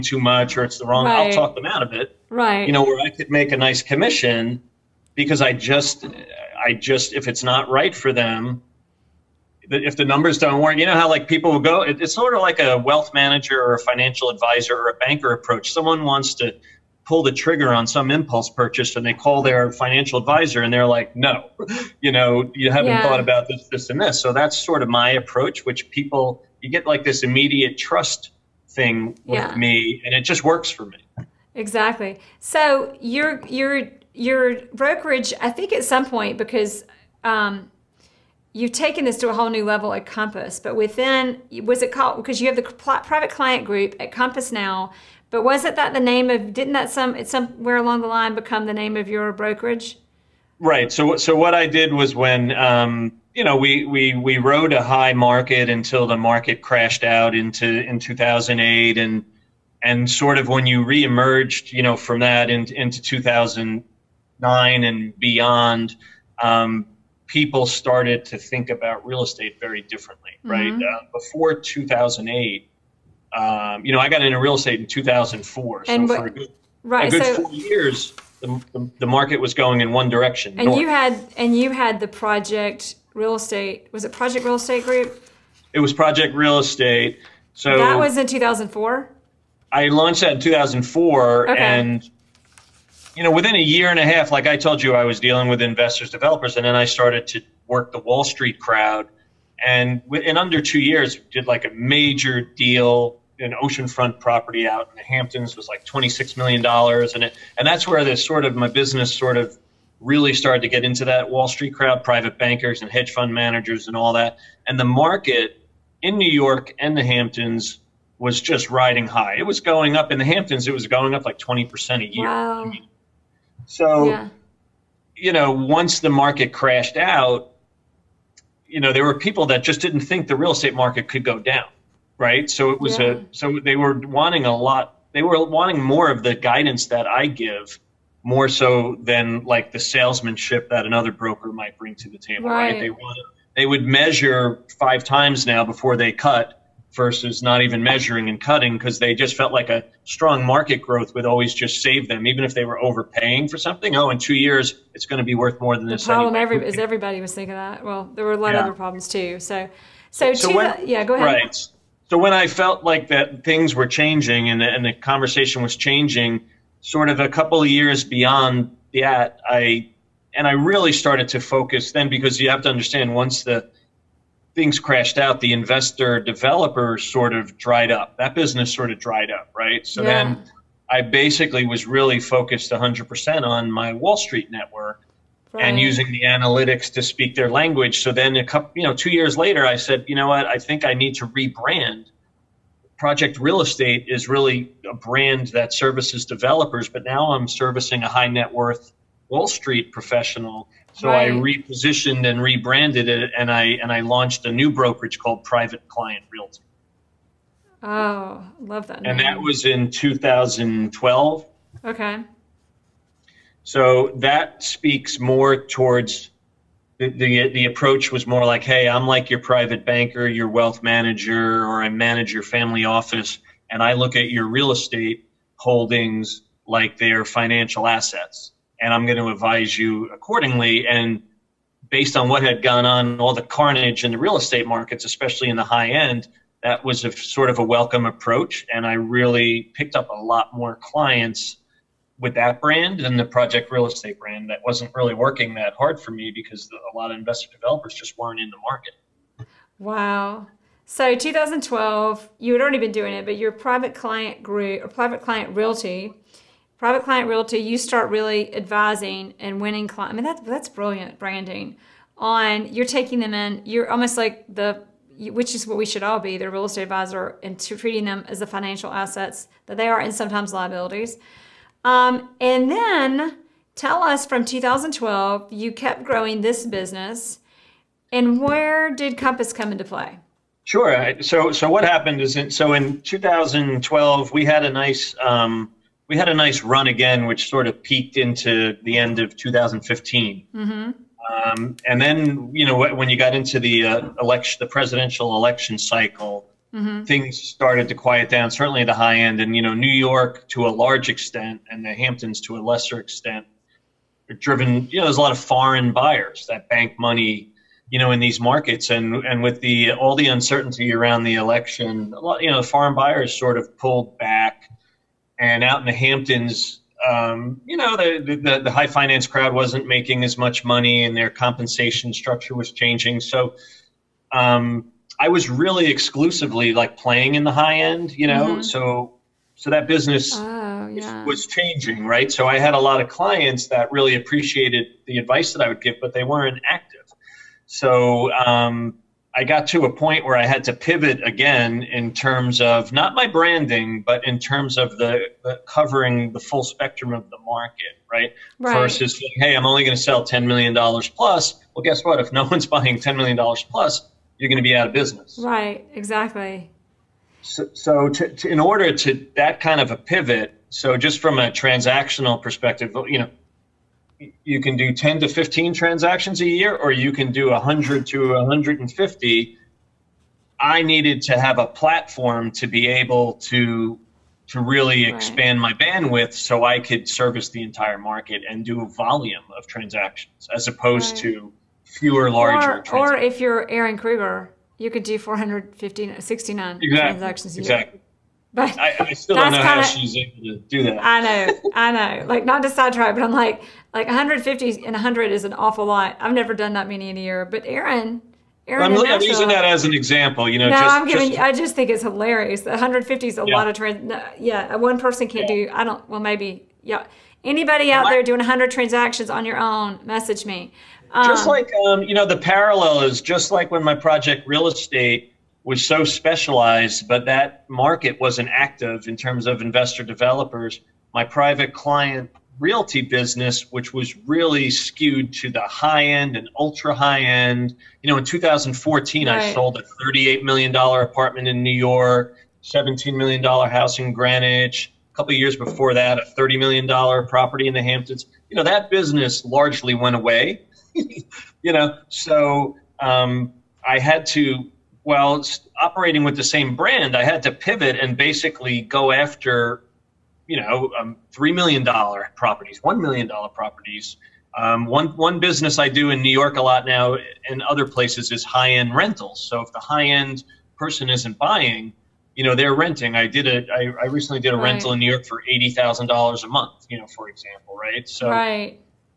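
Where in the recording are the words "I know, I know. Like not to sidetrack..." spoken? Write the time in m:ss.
6:31.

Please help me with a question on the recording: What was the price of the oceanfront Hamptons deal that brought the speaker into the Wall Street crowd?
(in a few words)
$26 million.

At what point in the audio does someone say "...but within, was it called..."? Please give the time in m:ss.
0:40.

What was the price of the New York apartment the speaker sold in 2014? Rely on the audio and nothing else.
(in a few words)
$38 million.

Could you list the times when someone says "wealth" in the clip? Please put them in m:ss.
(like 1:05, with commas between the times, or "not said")
0:12, 3:40.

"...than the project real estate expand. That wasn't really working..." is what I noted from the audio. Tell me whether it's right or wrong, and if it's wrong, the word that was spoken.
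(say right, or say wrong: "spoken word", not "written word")
wrong: "brand", not "expand".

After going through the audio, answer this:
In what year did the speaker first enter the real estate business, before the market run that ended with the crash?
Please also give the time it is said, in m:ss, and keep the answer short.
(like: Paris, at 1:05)
2004, at 1:13.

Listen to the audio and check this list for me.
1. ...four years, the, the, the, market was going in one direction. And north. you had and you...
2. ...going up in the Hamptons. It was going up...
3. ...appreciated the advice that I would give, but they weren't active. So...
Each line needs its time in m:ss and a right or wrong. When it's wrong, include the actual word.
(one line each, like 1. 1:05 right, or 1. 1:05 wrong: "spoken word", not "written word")
1. 1:17 right
2. 1:59 right
3. 5:34 right.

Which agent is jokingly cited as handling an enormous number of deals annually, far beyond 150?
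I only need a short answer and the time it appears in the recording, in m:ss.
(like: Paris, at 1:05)
Aaron Krieger, at 6:23.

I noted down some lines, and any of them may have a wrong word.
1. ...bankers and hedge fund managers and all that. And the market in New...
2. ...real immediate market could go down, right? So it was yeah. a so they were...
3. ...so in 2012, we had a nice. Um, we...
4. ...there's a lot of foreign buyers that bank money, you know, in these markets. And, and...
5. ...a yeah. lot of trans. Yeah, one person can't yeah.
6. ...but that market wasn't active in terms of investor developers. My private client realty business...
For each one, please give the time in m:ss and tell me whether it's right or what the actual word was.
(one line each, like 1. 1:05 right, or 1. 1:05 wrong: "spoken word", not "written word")
1. 1:52 right
2. 2:10 wrong: "estate", not "immediate"
3. 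4:42 right
4. 5:05 right
5. 6:43 right
6. 6:57 right.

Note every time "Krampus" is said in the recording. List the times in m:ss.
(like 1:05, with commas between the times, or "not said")
not said.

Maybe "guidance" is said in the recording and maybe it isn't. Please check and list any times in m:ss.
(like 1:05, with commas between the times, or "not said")
2:16.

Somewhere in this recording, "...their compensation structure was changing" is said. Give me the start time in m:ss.
5:21.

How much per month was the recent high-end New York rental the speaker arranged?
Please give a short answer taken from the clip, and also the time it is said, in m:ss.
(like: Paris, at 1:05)
$80,000, at 7:45.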